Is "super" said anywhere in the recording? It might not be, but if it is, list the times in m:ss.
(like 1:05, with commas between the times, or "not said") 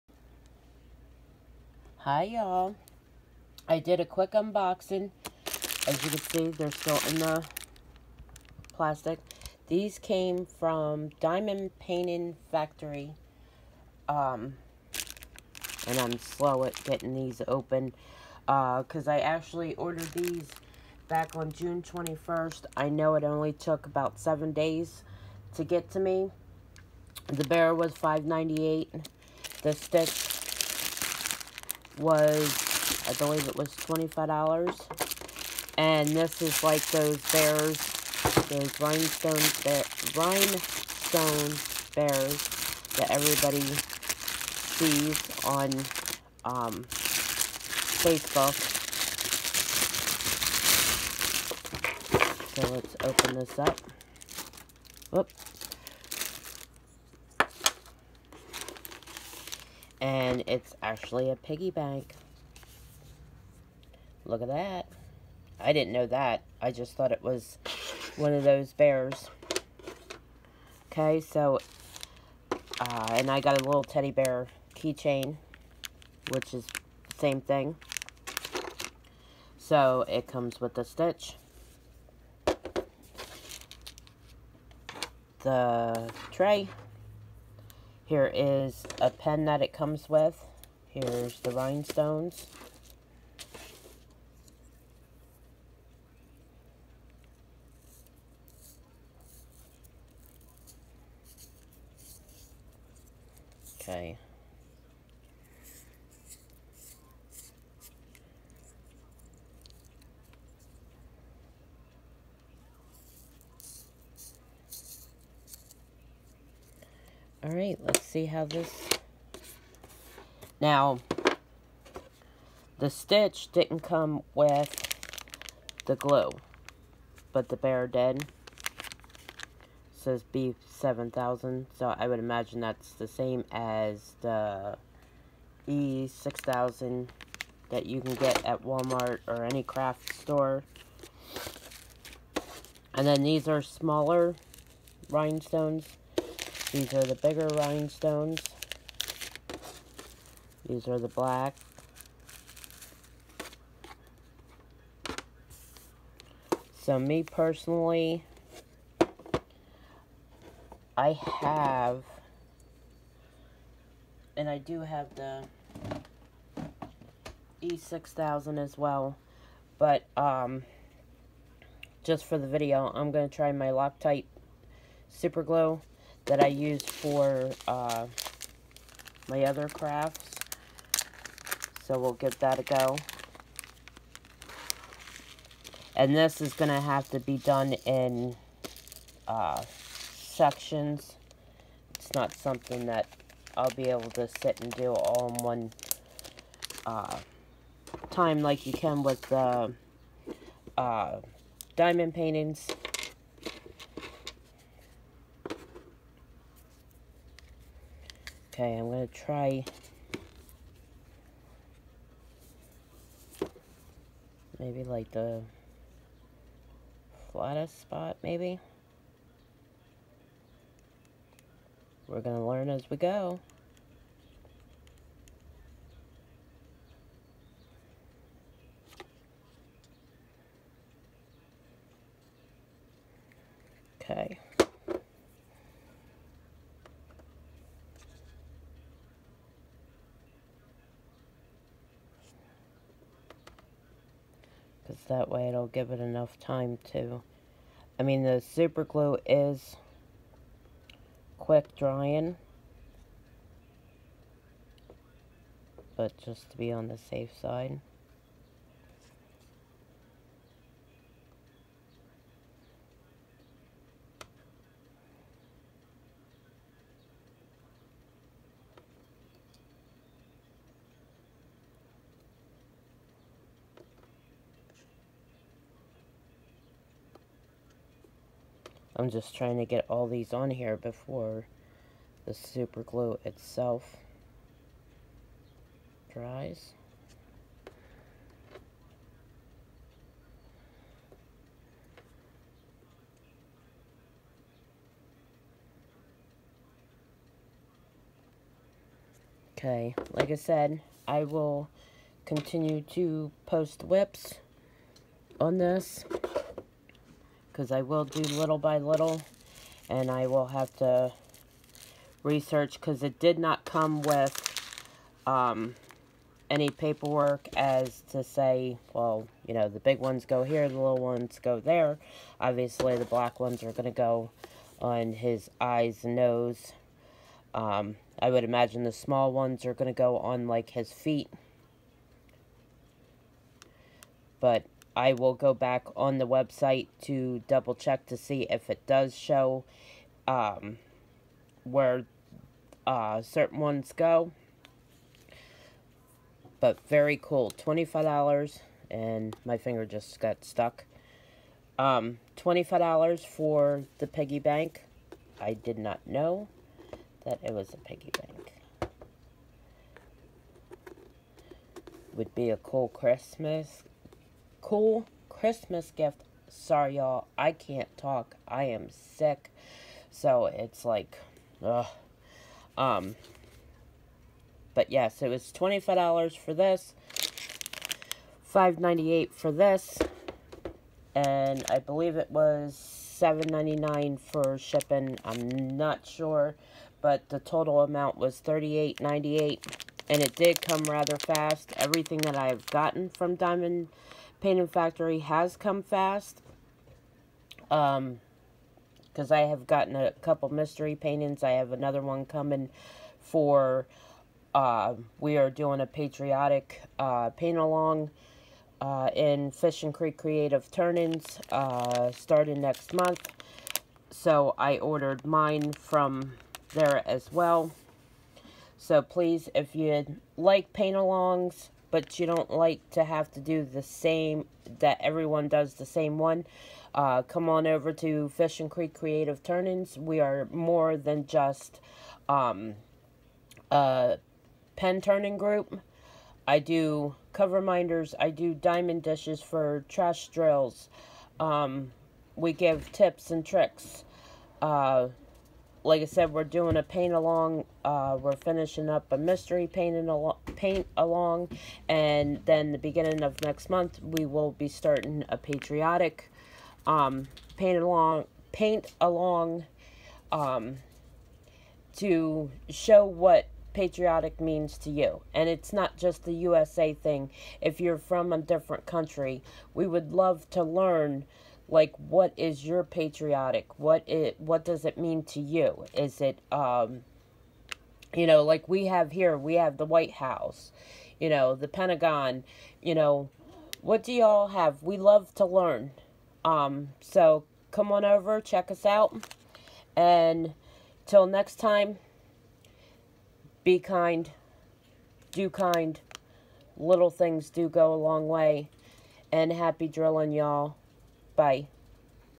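2:55, 4:08, 4:42.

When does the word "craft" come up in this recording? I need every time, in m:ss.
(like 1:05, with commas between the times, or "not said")
2:19, 2:59.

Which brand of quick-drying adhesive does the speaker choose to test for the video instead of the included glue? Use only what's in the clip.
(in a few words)
Loctite.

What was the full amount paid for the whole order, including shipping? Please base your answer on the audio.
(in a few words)
$38.98.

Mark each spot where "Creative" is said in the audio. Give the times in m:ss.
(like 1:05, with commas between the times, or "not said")
6:50, 7:08.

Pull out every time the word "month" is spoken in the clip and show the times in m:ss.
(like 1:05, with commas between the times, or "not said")
6:52, 7:33.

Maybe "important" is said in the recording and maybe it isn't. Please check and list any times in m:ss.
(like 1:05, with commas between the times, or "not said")
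not said.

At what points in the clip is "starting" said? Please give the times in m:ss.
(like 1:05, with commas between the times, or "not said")
6:52, 7:34.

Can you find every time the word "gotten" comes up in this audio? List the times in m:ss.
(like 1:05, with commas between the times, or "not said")
6:32, 6:39.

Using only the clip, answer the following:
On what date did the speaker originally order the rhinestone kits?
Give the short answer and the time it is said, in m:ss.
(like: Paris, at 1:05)
June 21st, at 0:21.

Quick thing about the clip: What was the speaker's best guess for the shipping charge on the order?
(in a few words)
$7.99.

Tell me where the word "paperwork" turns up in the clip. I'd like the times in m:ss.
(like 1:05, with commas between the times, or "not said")
5:16.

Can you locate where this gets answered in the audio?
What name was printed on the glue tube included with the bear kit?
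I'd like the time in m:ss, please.
2:10.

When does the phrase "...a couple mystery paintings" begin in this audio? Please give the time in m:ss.
6:39.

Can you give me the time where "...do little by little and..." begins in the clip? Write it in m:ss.
5:08.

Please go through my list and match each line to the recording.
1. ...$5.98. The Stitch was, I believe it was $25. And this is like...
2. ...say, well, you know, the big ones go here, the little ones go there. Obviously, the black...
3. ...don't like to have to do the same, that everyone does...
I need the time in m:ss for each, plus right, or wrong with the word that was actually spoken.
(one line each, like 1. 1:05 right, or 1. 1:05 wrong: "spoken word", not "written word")
1. 0:27 right
2. 5:18 right
3. 7:02 right.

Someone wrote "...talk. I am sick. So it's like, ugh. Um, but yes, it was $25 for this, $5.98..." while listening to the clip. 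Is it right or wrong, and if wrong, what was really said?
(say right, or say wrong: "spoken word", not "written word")
right.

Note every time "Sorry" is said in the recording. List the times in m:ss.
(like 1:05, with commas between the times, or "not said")
6:06.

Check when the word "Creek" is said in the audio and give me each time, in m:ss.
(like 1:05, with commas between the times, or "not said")
6:49, 7:08.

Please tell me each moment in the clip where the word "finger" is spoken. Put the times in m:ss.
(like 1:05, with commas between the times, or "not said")
5:49.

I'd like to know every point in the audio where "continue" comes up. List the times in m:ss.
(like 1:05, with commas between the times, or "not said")
5:02.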